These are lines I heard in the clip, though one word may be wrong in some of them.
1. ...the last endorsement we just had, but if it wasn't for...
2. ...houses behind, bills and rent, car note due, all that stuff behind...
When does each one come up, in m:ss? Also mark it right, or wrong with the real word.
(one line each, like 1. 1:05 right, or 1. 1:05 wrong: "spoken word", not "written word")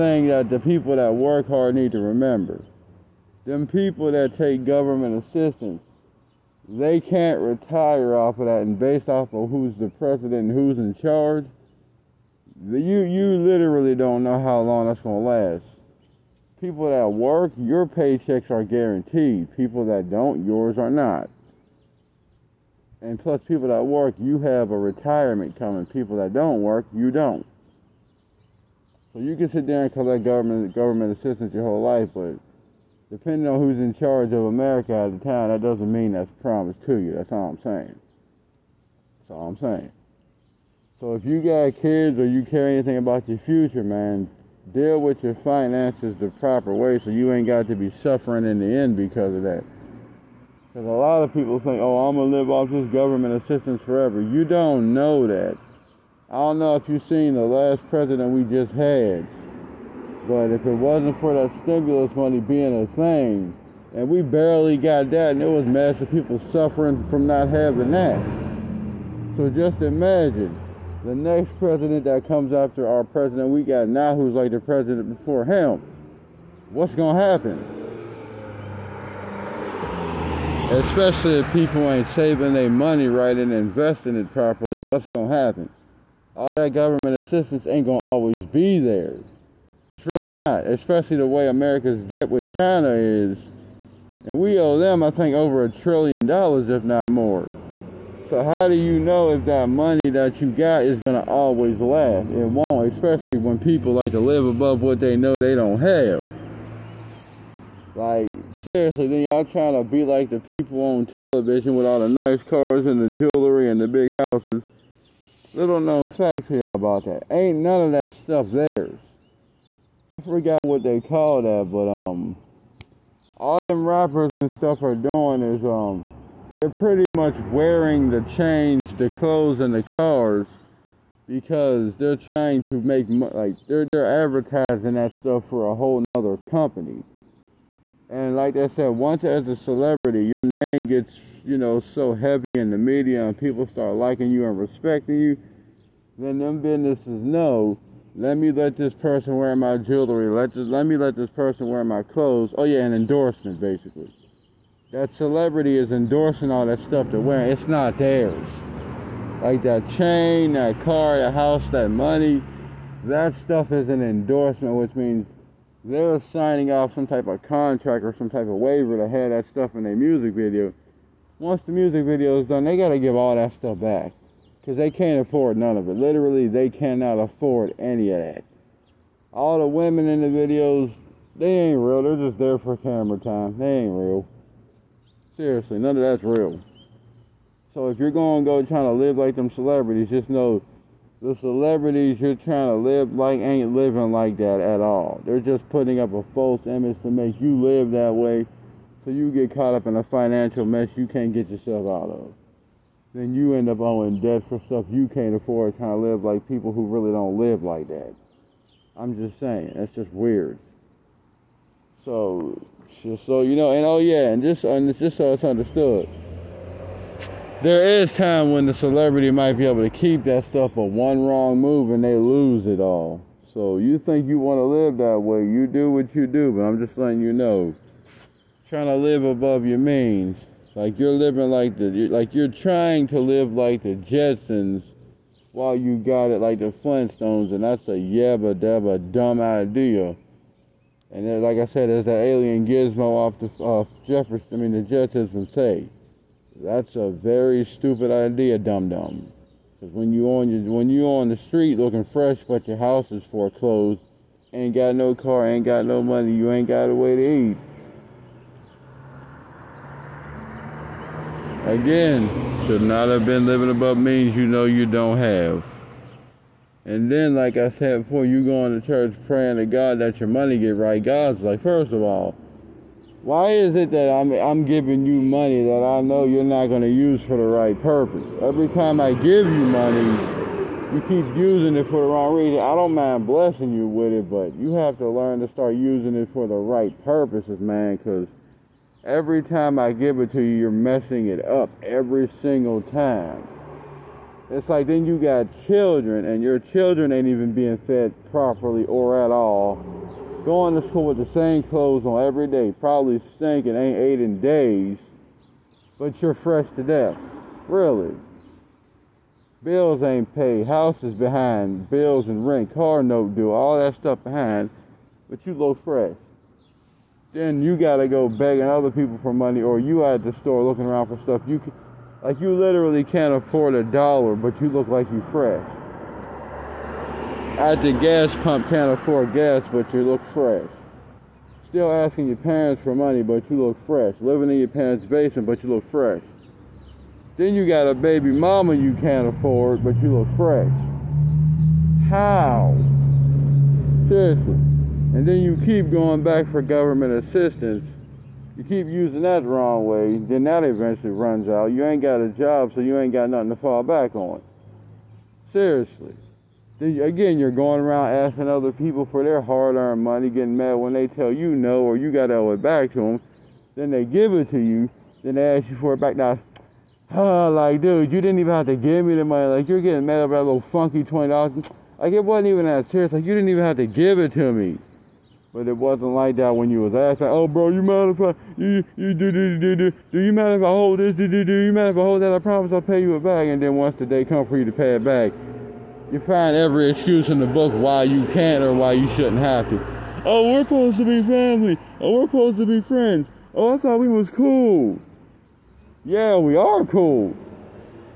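1. 0:57 wrong: "president", not "endorsement"
2. 5:10 right.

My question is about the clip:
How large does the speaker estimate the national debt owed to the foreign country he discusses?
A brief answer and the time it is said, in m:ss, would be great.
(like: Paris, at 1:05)
over a trillion dollars, at 1:35.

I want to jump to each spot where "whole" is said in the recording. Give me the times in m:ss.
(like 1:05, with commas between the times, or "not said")
0:31, 2:15.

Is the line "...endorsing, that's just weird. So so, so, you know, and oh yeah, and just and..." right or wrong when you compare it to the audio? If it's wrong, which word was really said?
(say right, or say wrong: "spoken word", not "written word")
wrong: "saying", not "endorsing".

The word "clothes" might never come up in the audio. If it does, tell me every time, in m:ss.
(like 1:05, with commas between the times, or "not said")
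2:09, 2:32, 5:01.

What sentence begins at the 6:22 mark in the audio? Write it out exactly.
I promise I'll pay you it back.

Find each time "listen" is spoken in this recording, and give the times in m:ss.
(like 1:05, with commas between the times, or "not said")
not said.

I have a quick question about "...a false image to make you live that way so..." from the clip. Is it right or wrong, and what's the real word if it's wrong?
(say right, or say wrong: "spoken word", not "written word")
right.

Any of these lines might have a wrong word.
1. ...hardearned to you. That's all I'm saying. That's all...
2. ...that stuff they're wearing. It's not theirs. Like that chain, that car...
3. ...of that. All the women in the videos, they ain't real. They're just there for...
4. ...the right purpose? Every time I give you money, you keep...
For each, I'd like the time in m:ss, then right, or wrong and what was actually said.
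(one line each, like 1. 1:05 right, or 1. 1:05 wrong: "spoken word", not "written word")
1. 0:36 wrong: "promised", not "hardearned"
2. 2:36 right
3. 2:58 right
4. 4:37 right.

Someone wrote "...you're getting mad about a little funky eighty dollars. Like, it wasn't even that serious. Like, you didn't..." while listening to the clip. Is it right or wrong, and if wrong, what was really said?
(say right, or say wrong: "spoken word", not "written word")
wrong: "twenty", not "eighty".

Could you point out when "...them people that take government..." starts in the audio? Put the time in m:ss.
0:03.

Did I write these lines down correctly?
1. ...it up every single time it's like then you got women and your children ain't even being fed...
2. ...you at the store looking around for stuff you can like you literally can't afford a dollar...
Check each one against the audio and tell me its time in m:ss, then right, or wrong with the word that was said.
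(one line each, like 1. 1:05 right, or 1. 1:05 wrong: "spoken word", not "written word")
1. 4:51 wrong: "children", not "women"
2. 5:19 right.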